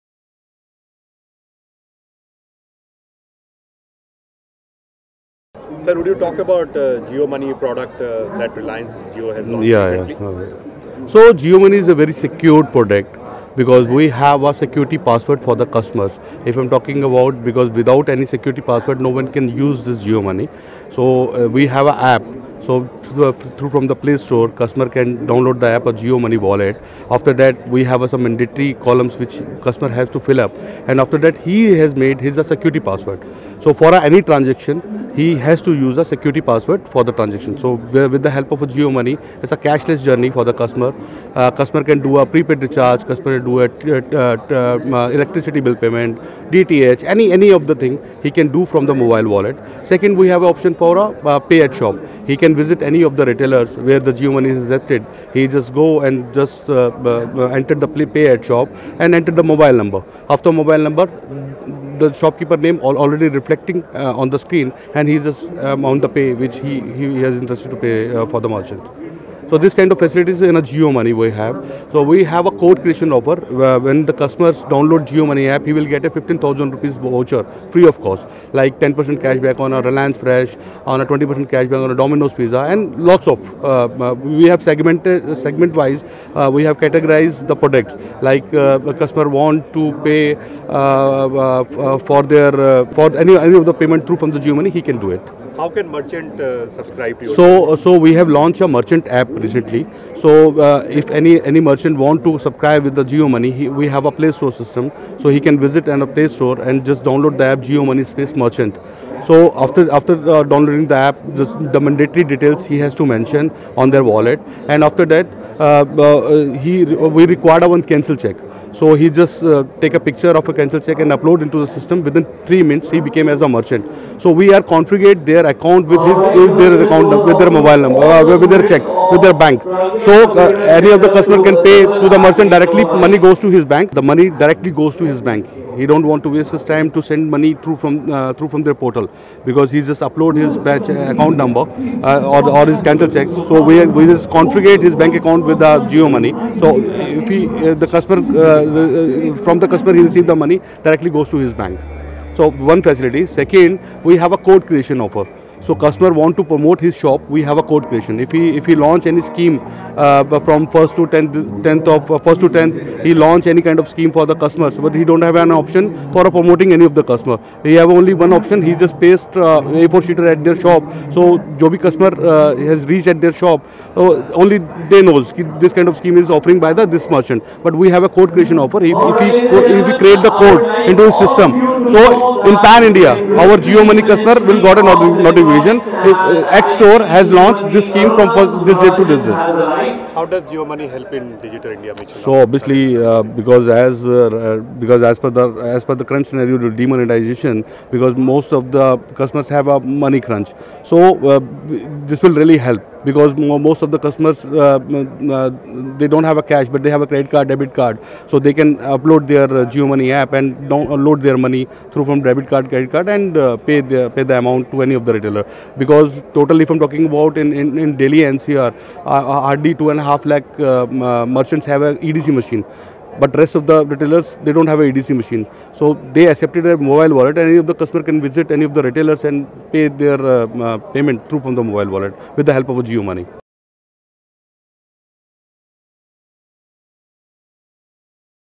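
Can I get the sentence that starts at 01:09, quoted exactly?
So this kind of facilities in a Jio Money we have.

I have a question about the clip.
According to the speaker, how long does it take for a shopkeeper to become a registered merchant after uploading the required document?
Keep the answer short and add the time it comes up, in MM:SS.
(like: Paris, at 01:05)
3 minutes, at 02:02.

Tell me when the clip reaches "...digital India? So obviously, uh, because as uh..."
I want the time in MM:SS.
03:11.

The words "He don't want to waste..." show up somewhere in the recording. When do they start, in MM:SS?
02:15.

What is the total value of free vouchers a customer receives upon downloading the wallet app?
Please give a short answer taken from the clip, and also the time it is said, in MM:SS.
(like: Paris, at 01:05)
15,000 rupees, at 01:16.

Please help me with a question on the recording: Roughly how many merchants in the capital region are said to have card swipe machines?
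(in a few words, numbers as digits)
2.5 lakh.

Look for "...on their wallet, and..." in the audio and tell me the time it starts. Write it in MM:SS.
01:53.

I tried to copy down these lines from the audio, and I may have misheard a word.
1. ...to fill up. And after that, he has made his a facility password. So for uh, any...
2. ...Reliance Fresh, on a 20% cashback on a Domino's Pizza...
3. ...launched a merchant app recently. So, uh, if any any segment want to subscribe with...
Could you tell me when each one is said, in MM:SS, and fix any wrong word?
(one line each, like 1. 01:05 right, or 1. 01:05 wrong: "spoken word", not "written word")
1. 00:30 wrong: "security", not "facility"
2. 01:19 right
3. 01:38 wrong: "merchant", not "segment".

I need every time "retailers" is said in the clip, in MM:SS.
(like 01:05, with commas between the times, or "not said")
00:53, 03:35, 03:43, 03:48.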